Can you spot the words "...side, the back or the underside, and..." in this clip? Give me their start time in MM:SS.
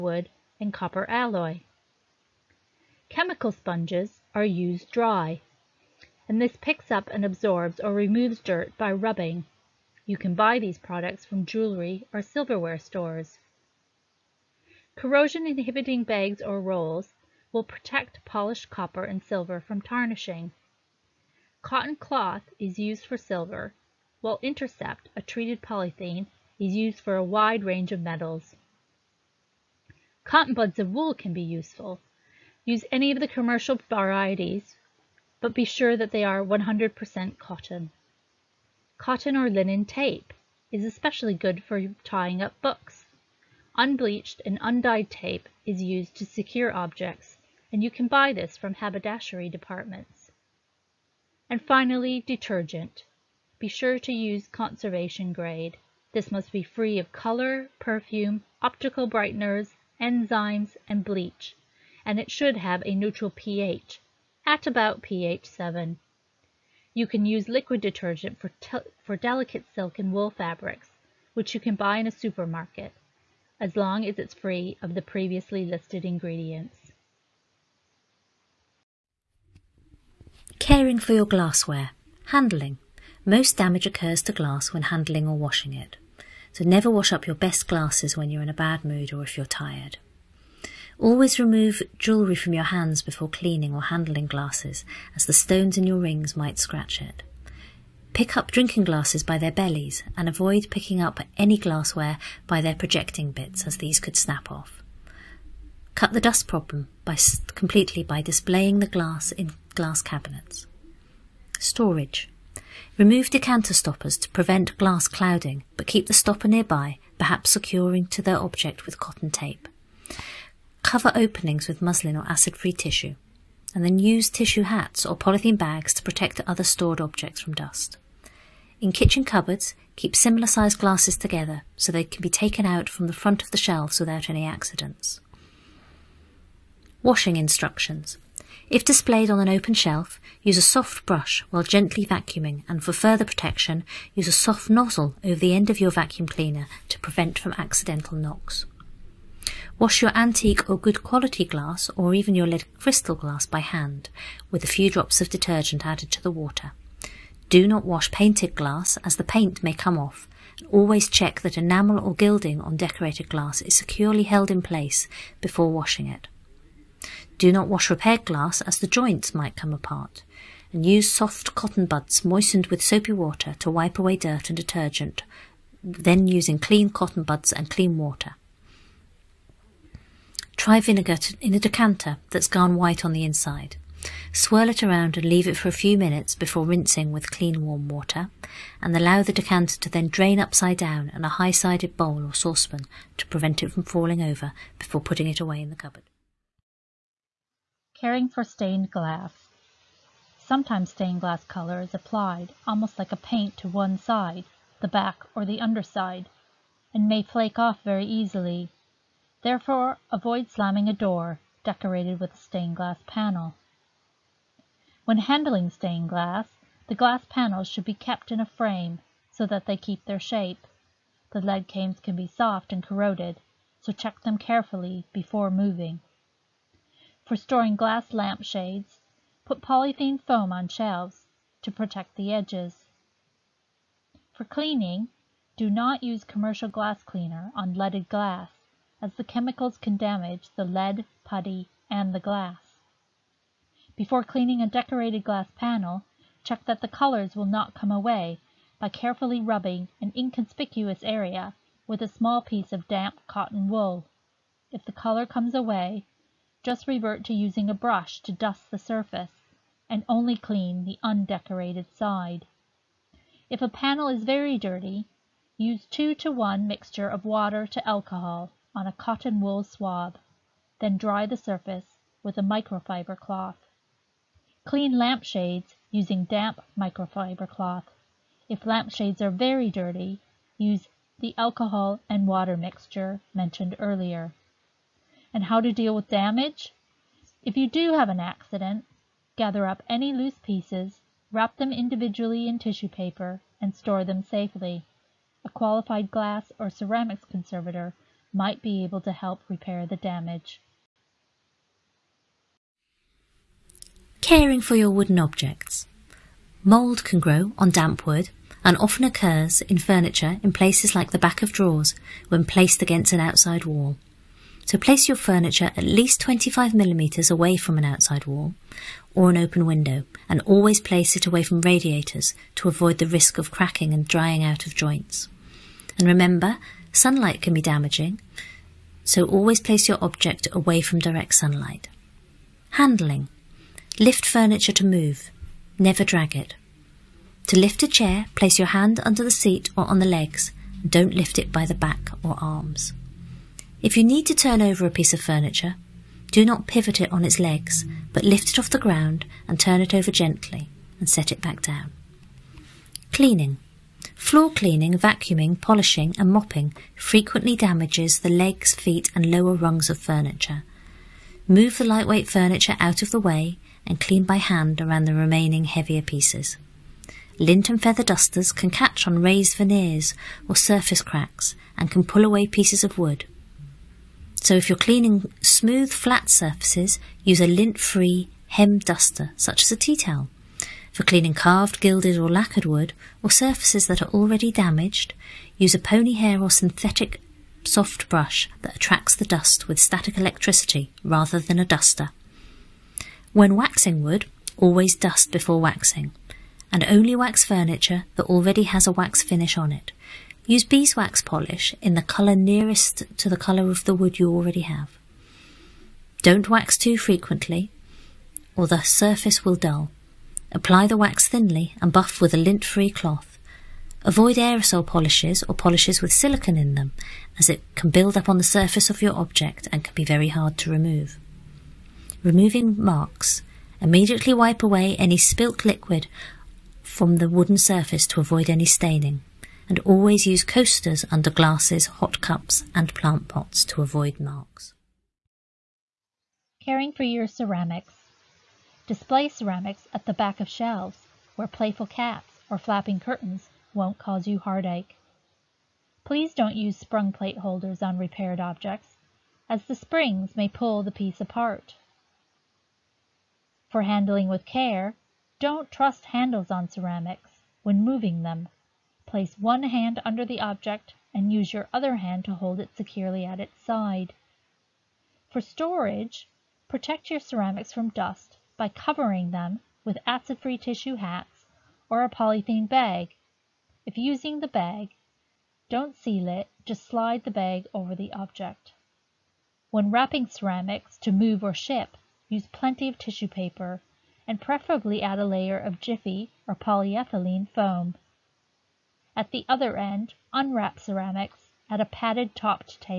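03:23.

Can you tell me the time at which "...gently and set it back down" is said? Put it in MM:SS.
05:50.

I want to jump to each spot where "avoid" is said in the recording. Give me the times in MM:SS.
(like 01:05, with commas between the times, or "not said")
01:40, 03:30, 05:22, 06:54, 07:08, 07:13.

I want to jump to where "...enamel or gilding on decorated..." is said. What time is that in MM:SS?
02:41.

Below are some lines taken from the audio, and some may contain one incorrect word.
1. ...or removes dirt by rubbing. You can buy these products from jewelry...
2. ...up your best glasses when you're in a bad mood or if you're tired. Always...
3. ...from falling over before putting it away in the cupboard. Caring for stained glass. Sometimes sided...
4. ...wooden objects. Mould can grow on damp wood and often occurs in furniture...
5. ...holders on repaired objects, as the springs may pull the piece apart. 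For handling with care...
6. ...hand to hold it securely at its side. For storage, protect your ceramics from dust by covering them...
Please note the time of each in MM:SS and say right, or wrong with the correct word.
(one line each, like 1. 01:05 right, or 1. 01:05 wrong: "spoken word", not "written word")
1. 00:07 right
2. 01:27 right
3. 03:13 wrong: "stained", not "sided"
4. 05:04 right
5. 07:27 right
6. 07:41 right.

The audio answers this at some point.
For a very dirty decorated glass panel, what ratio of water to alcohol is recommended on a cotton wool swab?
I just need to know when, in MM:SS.
04:25.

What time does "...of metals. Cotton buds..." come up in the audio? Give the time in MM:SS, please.
00:27.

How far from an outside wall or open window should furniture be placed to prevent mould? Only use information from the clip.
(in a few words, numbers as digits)
25mm.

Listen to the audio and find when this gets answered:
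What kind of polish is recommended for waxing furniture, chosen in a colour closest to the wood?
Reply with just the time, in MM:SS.
06:40.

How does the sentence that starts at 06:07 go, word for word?
Lint and feather dusters can catch on raised veneers or surface cracks and can pull away pieces of wood.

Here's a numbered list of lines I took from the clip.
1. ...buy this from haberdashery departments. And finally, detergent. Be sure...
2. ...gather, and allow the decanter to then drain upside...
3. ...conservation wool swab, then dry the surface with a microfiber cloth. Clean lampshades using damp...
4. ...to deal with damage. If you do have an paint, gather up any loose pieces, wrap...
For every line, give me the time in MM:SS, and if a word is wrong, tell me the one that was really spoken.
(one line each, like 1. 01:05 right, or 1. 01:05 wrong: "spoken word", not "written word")
1. 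00:48 right
2. 03:07 wrong: "water", not "gather"
3. 04:28 wrong: "cotton", not "conservation"
4. 04:45 wrong: "accident", not "paint".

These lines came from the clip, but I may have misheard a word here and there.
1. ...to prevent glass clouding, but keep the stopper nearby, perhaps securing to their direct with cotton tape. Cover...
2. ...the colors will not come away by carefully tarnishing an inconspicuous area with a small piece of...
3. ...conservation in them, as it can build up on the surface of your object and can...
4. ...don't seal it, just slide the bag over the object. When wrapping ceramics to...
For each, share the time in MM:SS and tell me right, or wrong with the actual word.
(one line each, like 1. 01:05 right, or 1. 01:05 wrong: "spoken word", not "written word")
1. 01:54 wrong: "object", not "direct"
2. 04:06 wrong: "rubbing", not "tarnishing"
3. 06:56 wrong: "silicon", not "conservation"
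4. 07:55 right.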